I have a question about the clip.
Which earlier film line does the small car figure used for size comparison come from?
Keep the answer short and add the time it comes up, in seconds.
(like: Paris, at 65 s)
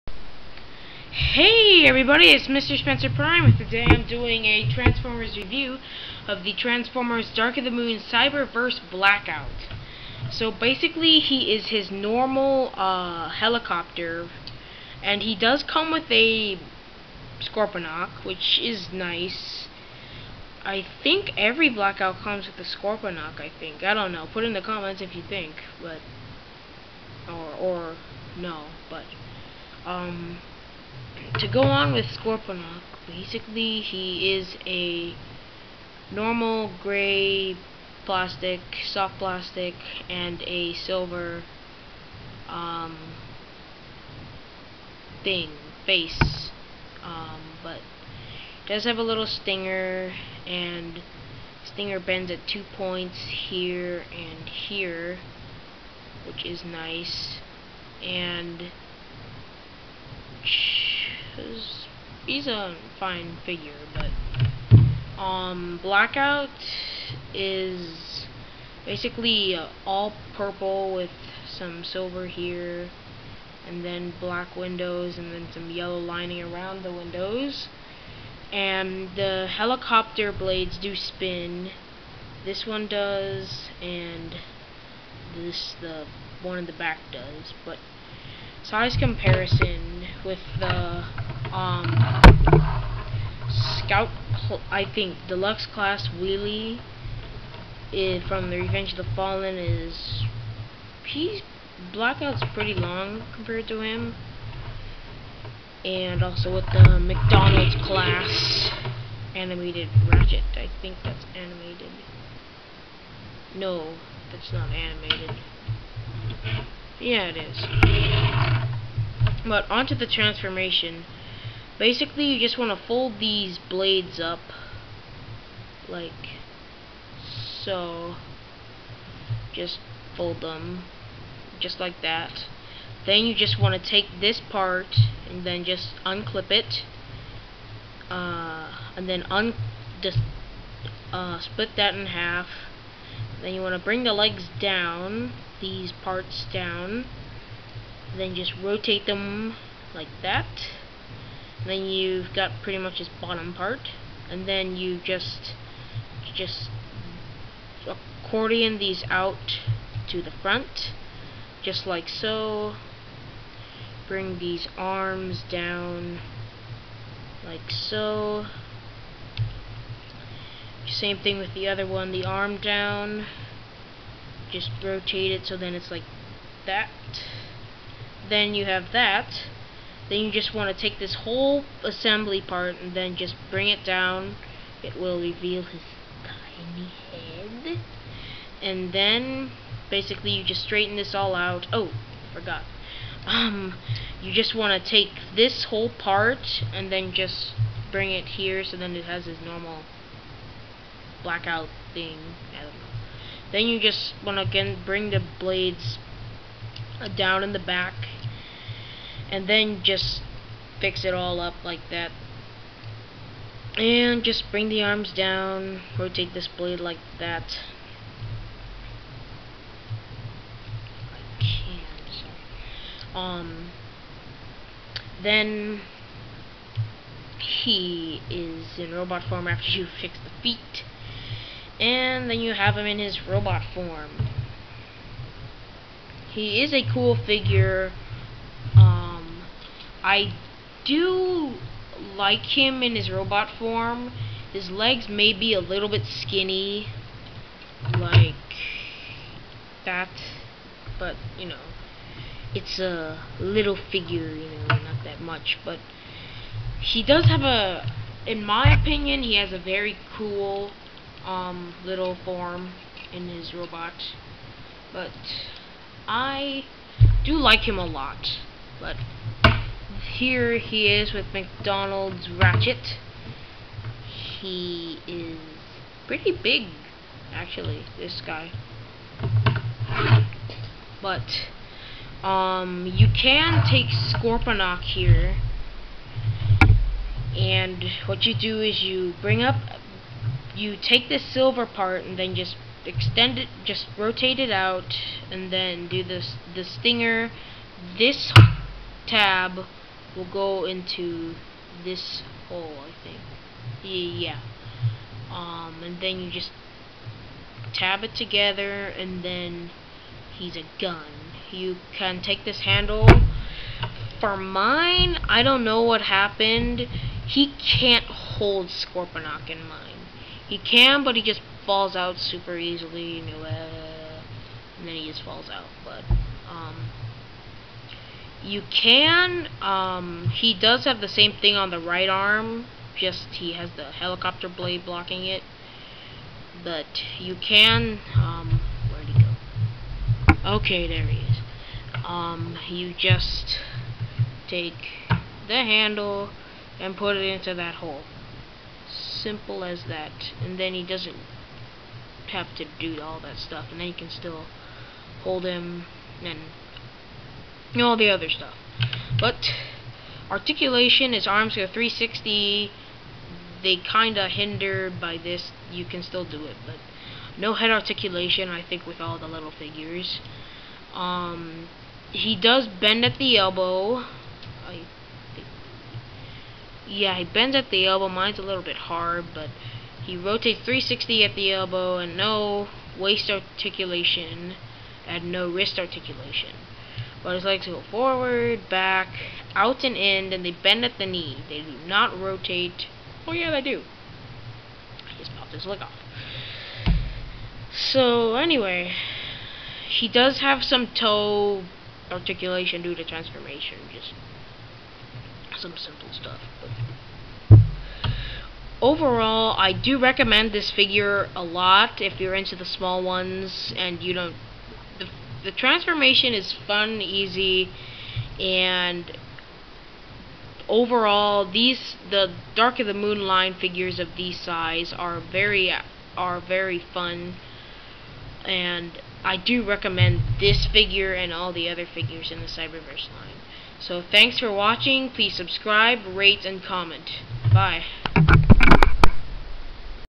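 Revenge of the Fallen, at 98 s.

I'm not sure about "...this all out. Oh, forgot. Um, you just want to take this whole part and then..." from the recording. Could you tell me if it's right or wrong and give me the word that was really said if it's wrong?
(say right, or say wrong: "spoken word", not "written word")
right.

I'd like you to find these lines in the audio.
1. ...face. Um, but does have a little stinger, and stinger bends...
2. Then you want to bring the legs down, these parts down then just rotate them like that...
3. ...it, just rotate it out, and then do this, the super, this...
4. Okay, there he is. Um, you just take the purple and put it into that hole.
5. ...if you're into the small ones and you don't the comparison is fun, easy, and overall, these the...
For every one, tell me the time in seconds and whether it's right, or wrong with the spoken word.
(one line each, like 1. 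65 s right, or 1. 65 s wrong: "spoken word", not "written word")
1. 45 s right
2. 143 s right
3. 293 s wrong: "stinger", not "super"
4. 340 s wrong: "handle", not "purple"
5. 412 s wrong: "transformation", not "comparison".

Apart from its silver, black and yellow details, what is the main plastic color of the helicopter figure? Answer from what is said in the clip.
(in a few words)
Purple.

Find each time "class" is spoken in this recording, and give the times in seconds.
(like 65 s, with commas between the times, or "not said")
95 s, 107 s.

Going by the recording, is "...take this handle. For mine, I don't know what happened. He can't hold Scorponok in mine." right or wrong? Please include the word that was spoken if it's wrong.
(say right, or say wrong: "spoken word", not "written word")
right.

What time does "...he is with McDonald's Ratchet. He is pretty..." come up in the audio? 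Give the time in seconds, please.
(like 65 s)
270 s.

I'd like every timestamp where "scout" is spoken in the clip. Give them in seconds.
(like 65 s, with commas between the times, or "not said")
93 s.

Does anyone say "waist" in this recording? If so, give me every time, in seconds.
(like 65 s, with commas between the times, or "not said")
382 s.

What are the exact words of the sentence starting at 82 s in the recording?
This one does, and this the one in the back does.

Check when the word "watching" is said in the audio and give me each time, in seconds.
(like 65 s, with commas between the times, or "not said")
434 s.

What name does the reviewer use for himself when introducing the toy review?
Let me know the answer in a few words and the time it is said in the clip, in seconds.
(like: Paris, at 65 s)
Mr. Spencer Prime, at 2 s.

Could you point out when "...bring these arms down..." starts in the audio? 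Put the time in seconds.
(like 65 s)
164 s.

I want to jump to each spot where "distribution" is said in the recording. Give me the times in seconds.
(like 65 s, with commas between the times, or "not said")
not said.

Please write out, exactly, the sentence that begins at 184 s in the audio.
It will reveal his tiny head.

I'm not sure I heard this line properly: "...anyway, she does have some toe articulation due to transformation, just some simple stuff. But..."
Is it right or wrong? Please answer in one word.
right.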